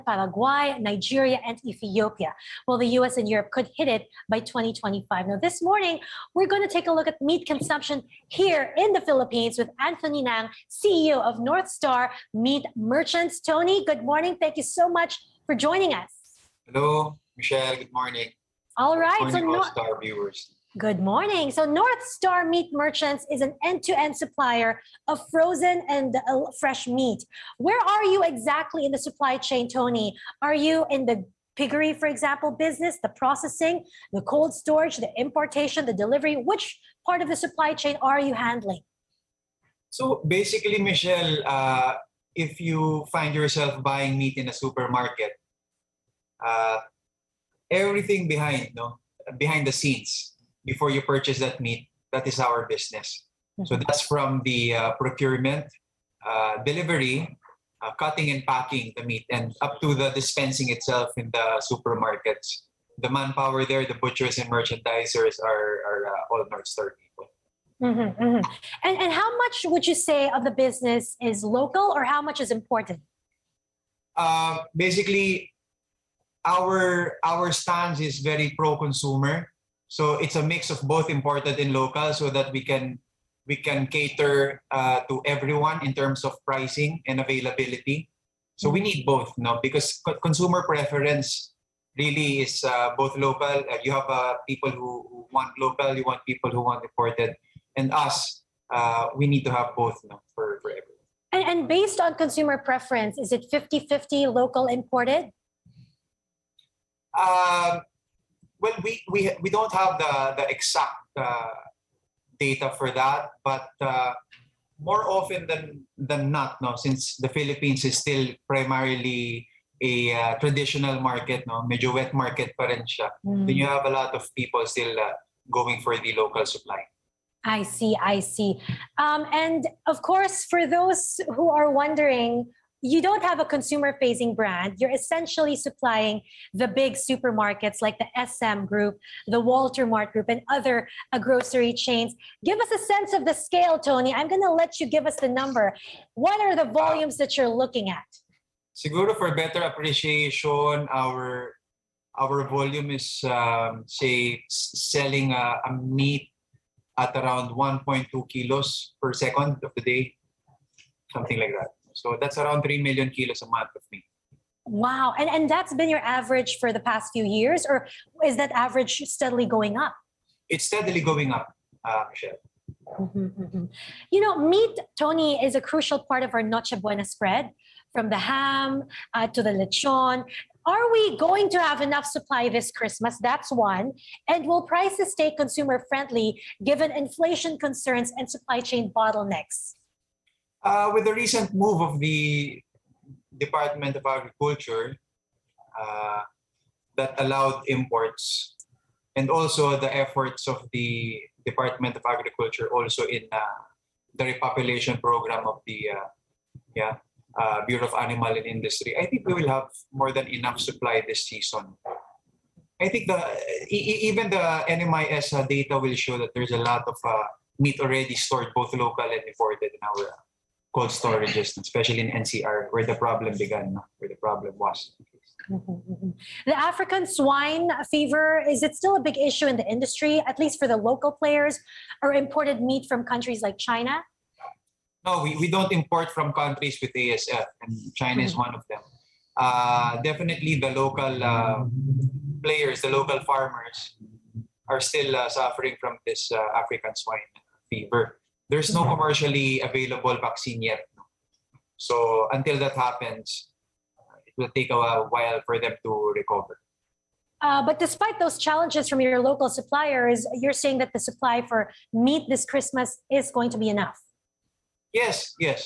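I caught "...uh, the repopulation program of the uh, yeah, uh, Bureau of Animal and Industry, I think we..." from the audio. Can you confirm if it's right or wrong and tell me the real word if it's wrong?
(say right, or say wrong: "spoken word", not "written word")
right.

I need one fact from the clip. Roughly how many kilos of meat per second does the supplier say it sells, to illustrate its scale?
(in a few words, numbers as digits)
1.2 kilos.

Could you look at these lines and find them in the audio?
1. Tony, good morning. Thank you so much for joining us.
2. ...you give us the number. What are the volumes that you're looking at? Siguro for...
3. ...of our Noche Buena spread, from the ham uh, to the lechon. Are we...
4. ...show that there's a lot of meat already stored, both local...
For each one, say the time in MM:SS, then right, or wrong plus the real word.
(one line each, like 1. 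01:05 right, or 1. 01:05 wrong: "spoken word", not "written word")
1. 00:13 right
2. 02:24 right
3. 02:56 right
4. 03:35 right.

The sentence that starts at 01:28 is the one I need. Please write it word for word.
So we need both now because co- consumer preference really is uh, both local.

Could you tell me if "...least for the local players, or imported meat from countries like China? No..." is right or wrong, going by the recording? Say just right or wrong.
right.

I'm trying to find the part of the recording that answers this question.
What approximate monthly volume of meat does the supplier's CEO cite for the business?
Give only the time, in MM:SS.
02:42.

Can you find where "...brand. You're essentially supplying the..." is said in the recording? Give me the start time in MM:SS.
02:14.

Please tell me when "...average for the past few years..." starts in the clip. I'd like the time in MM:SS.
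02:45.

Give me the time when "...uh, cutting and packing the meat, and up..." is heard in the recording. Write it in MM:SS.
00:57.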